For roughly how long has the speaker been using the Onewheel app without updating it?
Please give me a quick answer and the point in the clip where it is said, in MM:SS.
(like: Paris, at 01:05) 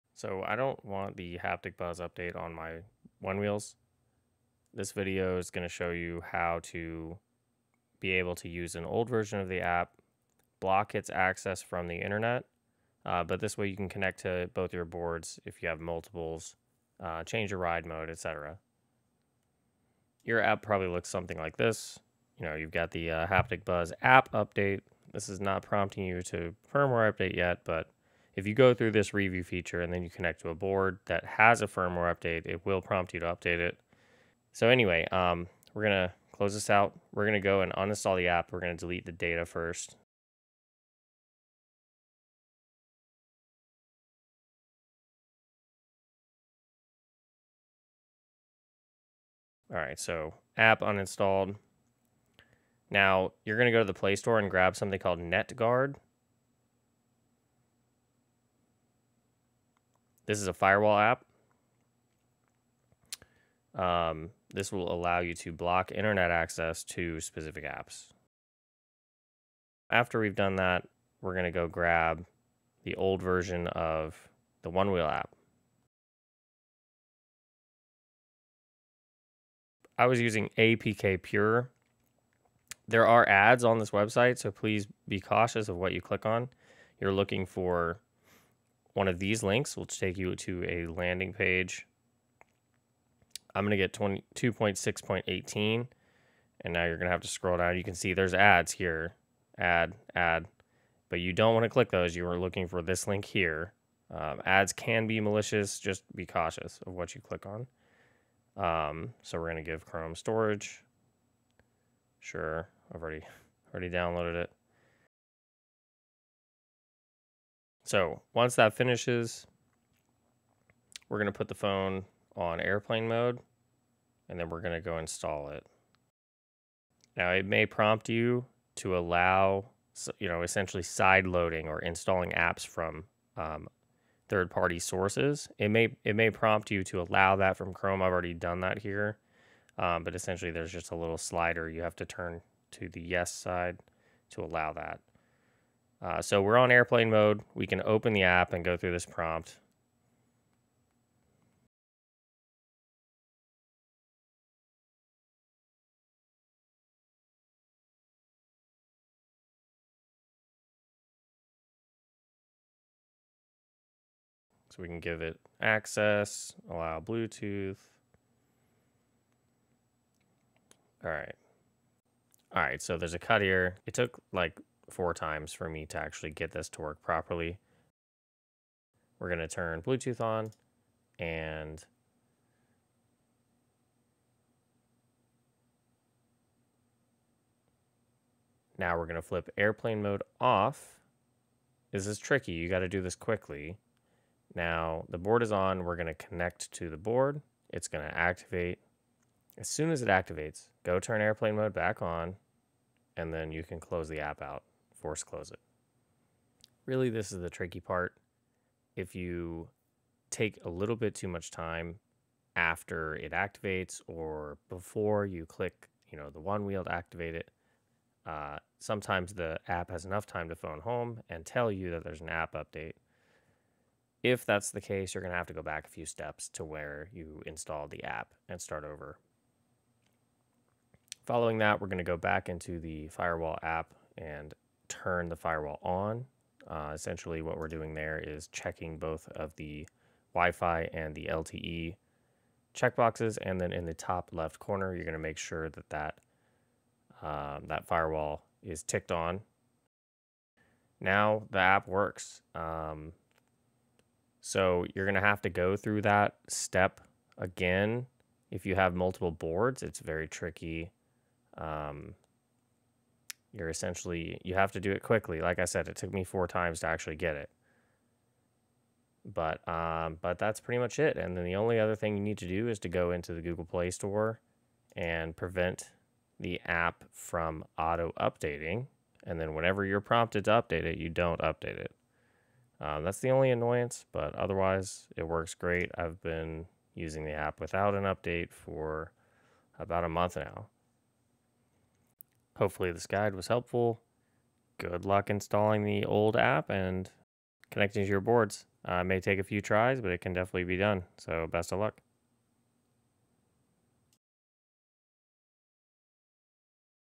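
about a month, at 04:49.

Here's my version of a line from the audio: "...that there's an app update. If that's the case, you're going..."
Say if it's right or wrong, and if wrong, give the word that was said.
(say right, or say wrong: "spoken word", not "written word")
right.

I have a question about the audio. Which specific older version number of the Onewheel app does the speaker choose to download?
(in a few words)
22.6.18.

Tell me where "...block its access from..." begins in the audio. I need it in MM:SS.
00:10.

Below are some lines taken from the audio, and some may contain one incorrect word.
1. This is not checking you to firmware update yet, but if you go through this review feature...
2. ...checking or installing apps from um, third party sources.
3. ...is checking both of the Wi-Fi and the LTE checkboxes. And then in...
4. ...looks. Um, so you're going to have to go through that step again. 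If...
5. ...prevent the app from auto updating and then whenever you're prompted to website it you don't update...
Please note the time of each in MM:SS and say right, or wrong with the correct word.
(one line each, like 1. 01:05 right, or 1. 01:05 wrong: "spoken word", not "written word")
1. 00:25 wrong: "prompting", not "checking"
2. 02:11 wrong: "loading", not "checking"
3. 03:58 right
4. 04:11 wrong: "works", not "looks"
5. 04:35 wrong: "update", not "website".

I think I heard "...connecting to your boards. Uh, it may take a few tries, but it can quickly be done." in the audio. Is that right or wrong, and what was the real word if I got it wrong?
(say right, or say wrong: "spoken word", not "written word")
wrong: "definitely", not "quickly".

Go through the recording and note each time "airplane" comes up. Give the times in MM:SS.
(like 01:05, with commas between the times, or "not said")
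02:02, 02:26, 03:09, 03:21.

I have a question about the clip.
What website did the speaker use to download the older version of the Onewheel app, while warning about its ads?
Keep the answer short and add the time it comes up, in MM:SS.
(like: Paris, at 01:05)
APKPure, at 01:20.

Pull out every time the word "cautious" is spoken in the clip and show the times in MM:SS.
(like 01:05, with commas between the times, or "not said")
01:25, 01:46.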